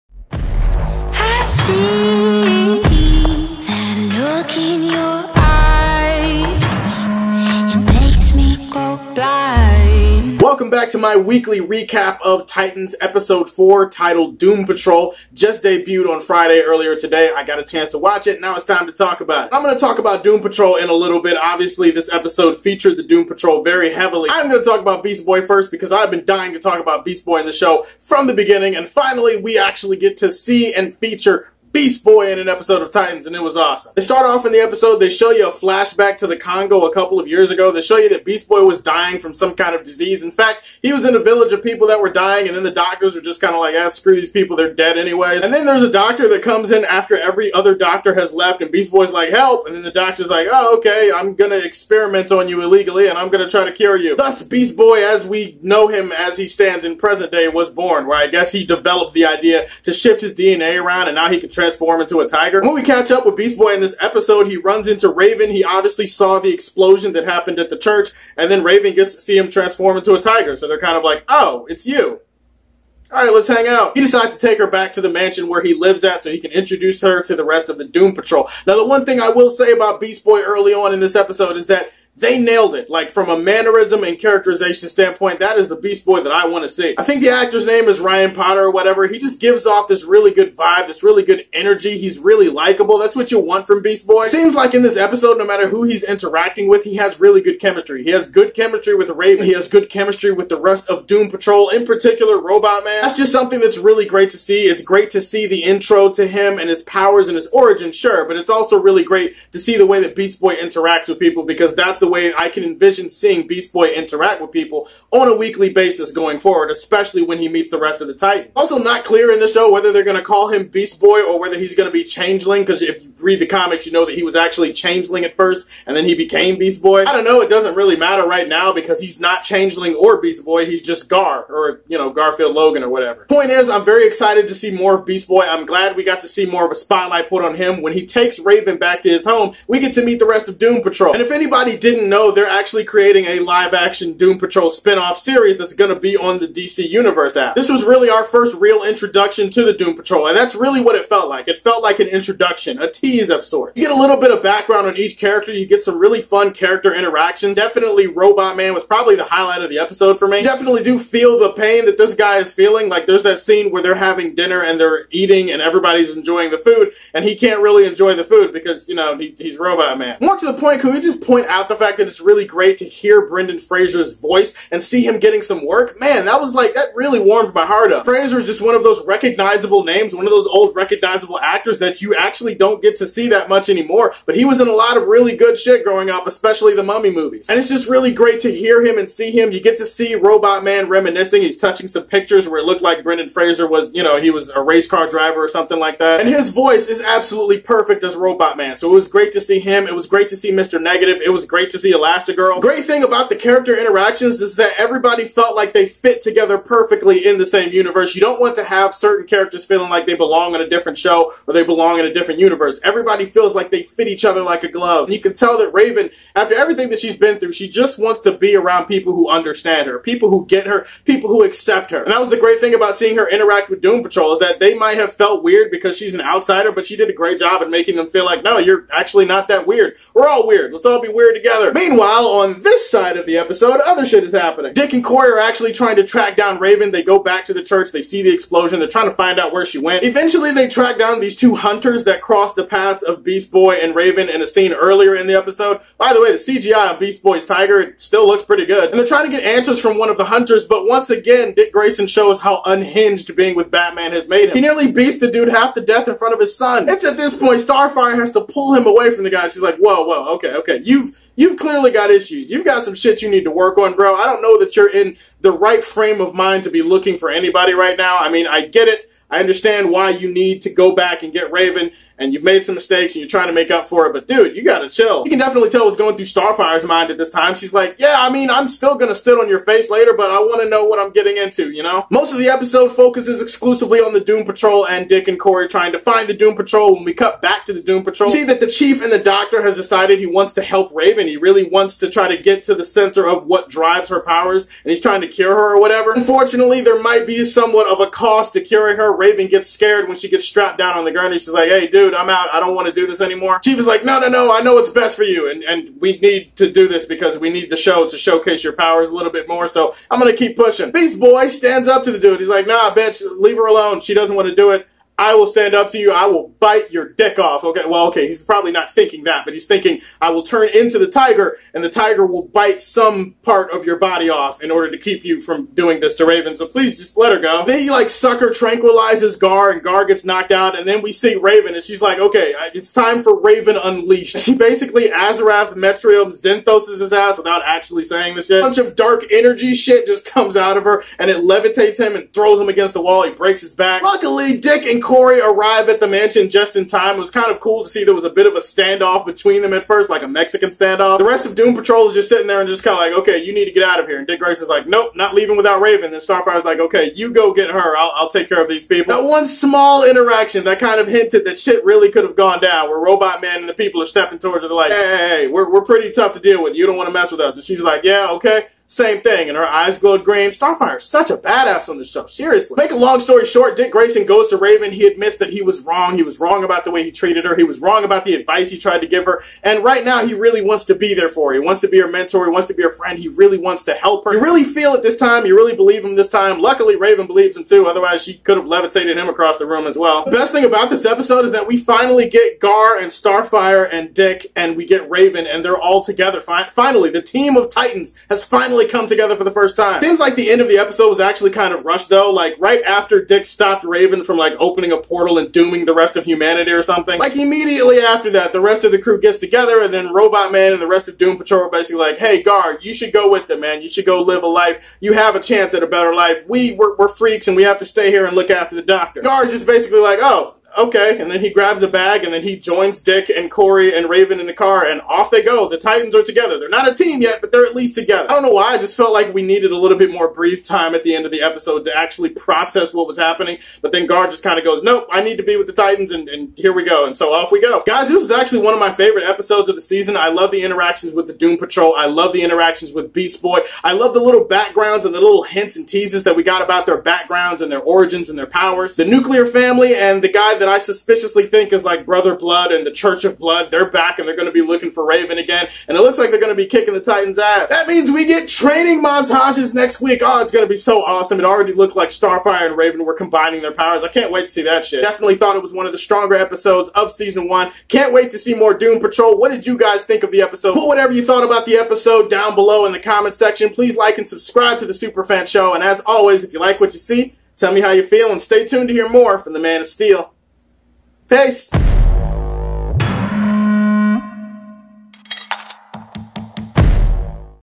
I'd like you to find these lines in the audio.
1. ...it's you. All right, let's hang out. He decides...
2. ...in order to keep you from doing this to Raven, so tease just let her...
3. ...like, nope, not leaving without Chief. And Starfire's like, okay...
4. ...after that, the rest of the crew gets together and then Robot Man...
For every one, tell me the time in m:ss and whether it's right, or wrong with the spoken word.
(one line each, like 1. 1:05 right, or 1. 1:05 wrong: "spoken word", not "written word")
1. 1:11 right
2. 5:24 wrong: "please", not "tease"
3. 5:54 wrong: "Raven", not "Chief"
4. 6:48 right.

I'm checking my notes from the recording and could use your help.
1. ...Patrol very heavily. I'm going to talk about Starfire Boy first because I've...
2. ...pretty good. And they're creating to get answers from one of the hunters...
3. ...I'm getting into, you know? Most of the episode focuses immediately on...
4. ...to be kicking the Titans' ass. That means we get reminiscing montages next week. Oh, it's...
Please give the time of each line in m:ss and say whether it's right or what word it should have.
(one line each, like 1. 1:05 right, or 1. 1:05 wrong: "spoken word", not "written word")
1. 0:23 wrong: "Beast", not "Starfire"
2. 4:08 wrong: "trying", not "creating"
3. 4:40 wrong: "exclusively", not "immediately"
4. 7:36 wrong: "training", not "reminiscing".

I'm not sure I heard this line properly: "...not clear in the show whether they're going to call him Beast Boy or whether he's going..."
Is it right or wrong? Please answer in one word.
right.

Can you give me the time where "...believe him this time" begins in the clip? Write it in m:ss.
6:25.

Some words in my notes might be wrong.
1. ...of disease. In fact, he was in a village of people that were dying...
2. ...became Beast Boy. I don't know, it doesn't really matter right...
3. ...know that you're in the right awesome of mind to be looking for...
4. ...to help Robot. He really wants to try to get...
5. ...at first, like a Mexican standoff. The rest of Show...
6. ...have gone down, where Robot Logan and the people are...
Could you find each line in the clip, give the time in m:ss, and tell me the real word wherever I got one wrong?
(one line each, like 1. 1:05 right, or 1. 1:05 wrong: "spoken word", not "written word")
1. 0:39 right
2. 2:06 right
3. 4:24 wrong: "frame", not "awesome"
4. 4:50 wrong: "Raven", not "Robot"
5. 5:49 wrong: "Doom", not "Show"
6. 6:02 wrong: "Man", not "Logan".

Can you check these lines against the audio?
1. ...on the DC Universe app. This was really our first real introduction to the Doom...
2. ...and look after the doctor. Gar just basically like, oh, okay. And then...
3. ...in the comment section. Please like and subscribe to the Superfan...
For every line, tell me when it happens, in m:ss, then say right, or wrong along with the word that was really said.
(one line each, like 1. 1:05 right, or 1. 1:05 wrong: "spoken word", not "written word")
1. 2:26 right
2. 6:58 right
3. 7:52 right.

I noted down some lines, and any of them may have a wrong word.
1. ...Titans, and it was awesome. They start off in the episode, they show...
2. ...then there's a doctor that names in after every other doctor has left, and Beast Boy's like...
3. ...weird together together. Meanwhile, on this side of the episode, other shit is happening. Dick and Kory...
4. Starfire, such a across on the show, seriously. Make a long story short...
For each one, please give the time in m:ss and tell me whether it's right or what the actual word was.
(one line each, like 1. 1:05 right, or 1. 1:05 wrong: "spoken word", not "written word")
1. 0:32 right
2. 0:45 wrong: "comes", not "names"
3. 3:51 right
4. 6:10 wrong: "badass", not "across".